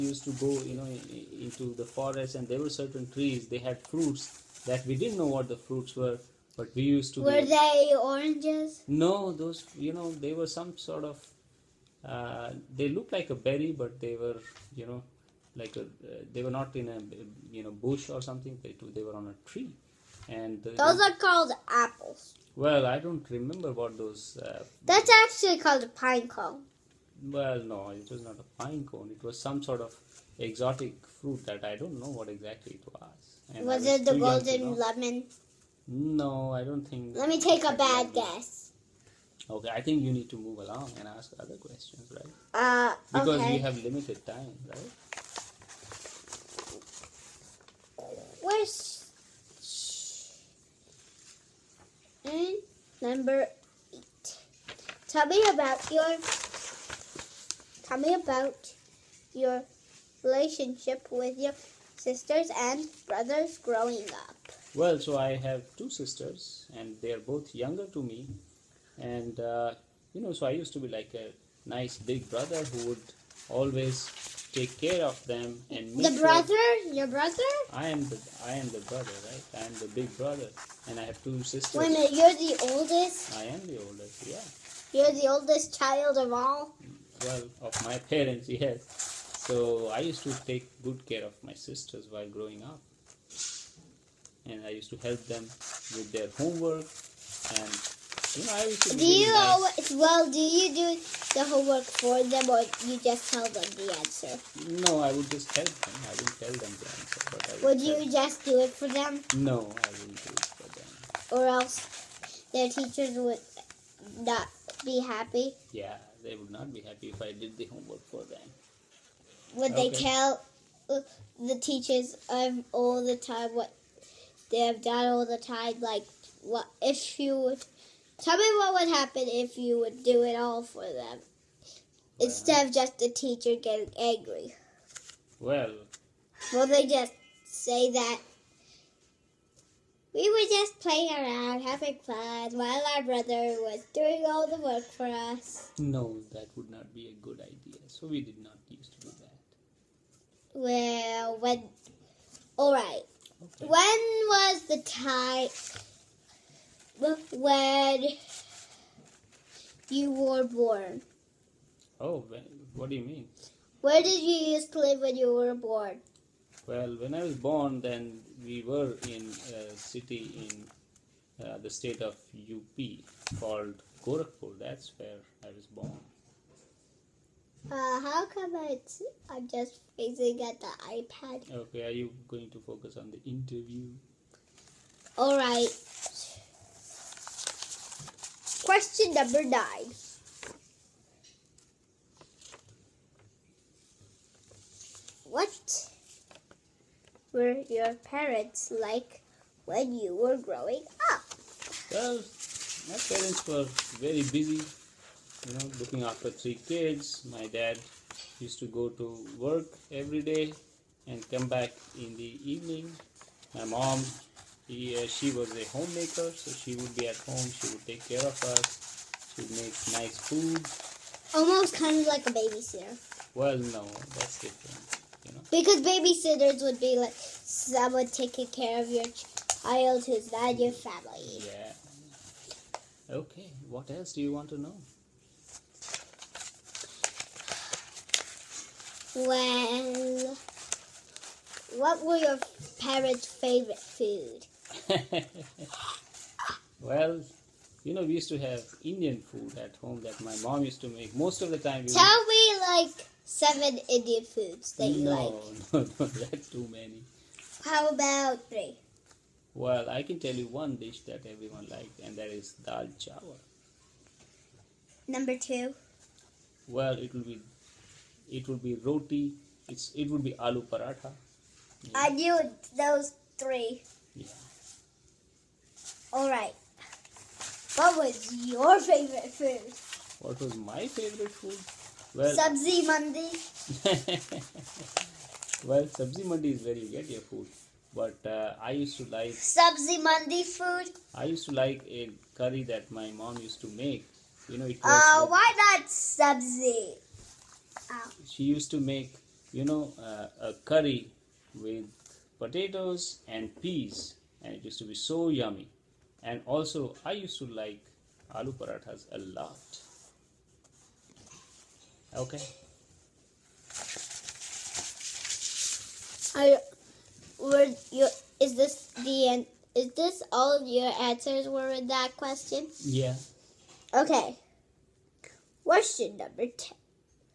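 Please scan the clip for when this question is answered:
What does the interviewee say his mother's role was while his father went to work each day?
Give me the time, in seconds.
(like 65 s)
215 s.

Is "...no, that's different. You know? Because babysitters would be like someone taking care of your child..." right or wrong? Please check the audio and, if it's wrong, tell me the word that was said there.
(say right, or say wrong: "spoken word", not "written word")
right.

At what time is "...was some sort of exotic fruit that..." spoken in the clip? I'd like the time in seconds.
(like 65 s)
29 s.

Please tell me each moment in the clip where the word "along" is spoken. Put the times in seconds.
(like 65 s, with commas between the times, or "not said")
40 s.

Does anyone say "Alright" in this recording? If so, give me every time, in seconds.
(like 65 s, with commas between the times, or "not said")
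152 s, 276 s.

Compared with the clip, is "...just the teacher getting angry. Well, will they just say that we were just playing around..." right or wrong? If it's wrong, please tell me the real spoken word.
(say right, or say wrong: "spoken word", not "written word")
right.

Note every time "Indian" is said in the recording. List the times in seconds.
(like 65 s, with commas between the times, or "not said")
248 s, 253 s.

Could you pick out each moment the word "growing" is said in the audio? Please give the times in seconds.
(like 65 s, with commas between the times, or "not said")
63 s, 92 s, 200 s.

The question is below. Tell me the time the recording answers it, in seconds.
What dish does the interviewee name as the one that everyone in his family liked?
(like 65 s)
262 s.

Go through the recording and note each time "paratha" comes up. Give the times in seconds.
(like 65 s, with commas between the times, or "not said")
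270 s, 308 s.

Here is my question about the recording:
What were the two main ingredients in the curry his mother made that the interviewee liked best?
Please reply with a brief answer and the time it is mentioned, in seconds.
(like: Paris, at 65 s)
Potatoes and peas, at 302 s.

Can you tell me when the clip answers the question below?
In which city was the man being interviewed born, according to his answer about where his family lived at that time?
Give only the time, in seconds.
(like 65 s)
174 s.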